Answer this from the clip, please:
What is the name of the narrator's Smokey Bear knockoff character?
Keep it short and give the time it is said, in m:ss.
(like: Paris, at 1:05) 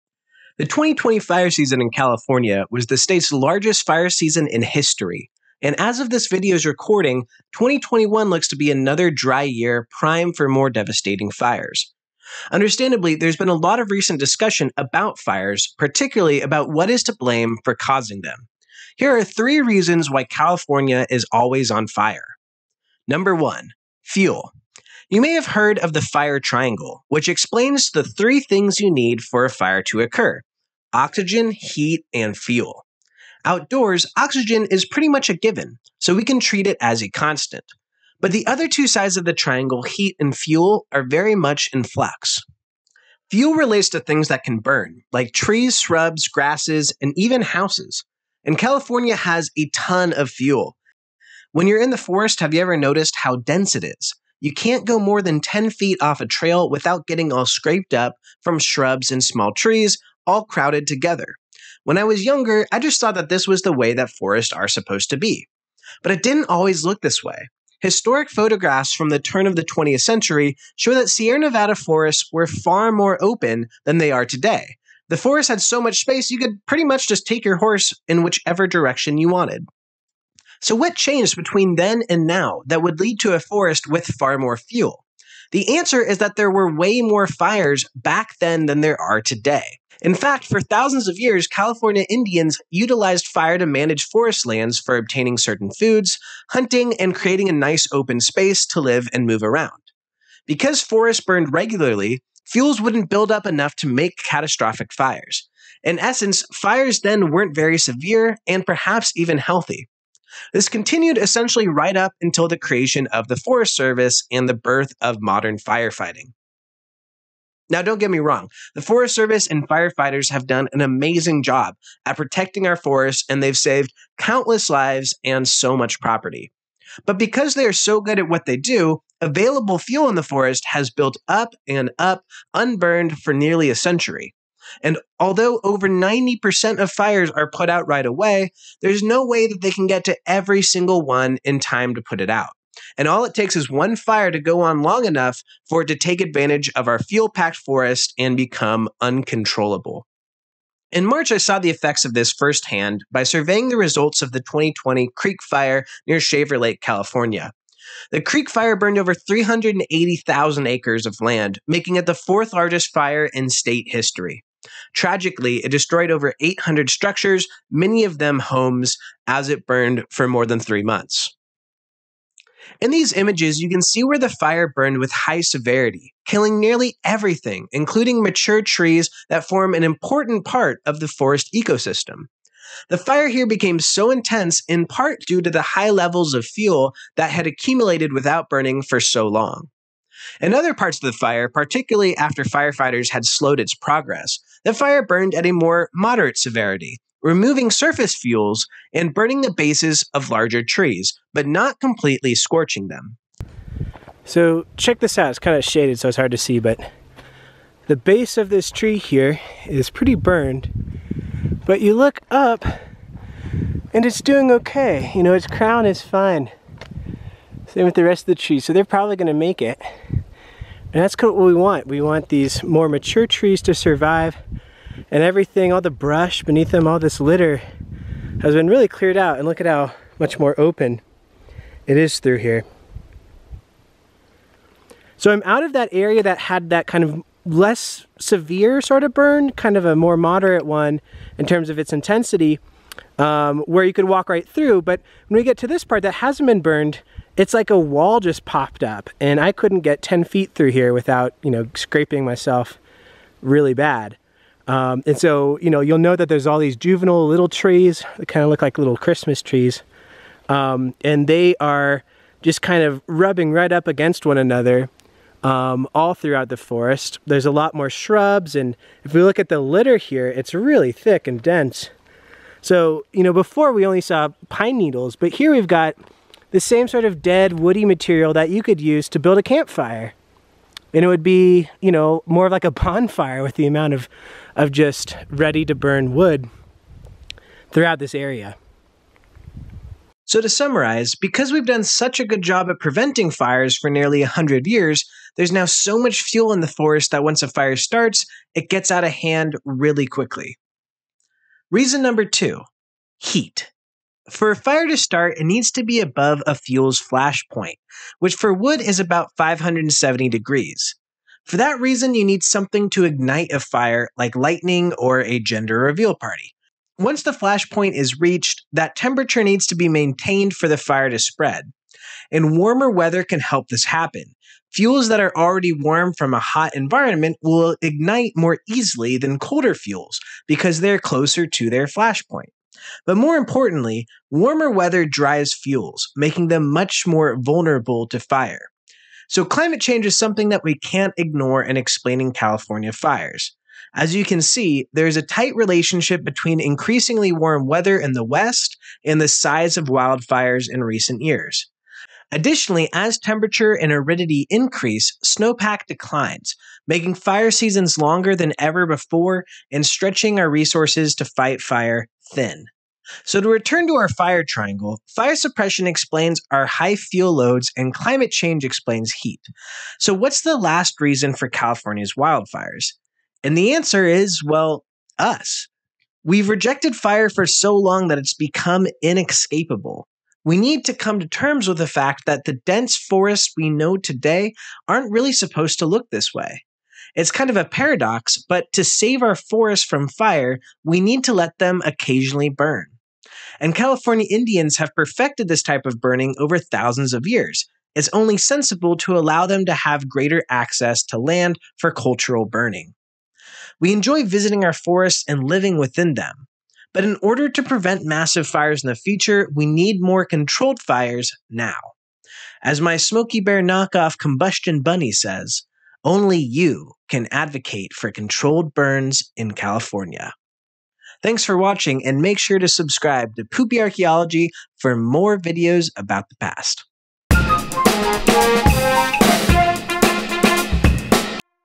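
Combustion Bunny, at 6:54.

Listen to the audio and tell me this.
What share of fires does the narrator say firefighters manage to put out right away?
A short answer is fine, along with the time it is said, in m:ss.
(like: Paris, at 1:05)
over 90%, at 2:15.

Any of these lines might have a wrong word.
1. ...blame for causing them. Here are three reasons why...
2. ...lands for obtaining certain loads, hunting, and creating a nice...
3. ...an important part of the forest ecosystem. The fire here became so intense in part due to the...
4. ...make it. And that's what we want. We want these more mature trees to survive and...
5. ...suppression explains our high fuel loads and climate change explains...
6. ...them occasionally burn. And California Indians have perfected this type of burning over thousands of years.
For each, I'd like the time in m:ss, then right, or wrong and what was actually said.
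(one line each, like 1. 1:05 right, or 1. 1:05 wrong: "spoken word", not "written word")
1. 0:17 right
2. 1:34 wrong: "foods", not "loads"
3. 2:59 right
4. 3:39 right
5. 6:05 right
6. 6:31 right.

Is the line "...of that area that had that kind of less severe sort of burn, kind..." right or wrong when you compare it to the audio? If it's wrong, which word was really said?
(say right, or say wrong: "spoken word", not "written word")
right.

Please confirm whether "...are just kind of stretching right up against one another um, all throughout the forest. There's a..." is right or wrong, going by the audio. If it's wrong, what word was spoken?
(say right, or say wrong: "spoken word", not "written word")
wrong: "rubbing", not "stretching".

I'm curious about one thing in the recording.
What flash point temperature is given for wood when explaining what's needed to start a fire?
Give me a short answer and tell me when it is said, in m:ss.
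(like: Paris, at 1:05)
570 degrees, at 5:09.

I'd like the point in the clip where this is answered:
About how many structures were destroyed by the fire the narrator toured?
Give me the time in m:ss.
2:46.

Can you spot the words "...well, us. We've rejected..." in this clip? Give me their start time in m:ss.
6:14.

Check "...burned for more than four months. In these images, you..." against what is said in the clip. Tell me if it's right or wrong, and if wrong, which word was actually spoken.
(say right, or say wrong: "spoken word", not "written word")
wrong: "three", not "four".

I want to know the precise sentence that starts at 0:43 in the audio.
Fuel relates to things that can burn, like trees, shrubs, grasses, and even houses.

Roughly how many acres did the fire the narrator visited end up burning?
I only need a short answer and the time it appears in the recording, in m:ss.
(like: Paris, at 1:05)
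380,000, at 2:39.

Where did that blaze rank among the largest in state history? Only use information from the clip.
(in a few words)
fourth.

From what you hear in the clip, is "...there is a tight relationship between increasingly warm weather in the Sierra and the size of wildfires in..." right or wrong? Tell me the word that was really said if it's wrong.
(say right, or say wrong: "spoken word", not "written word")
wrong: "West", not "Sierra".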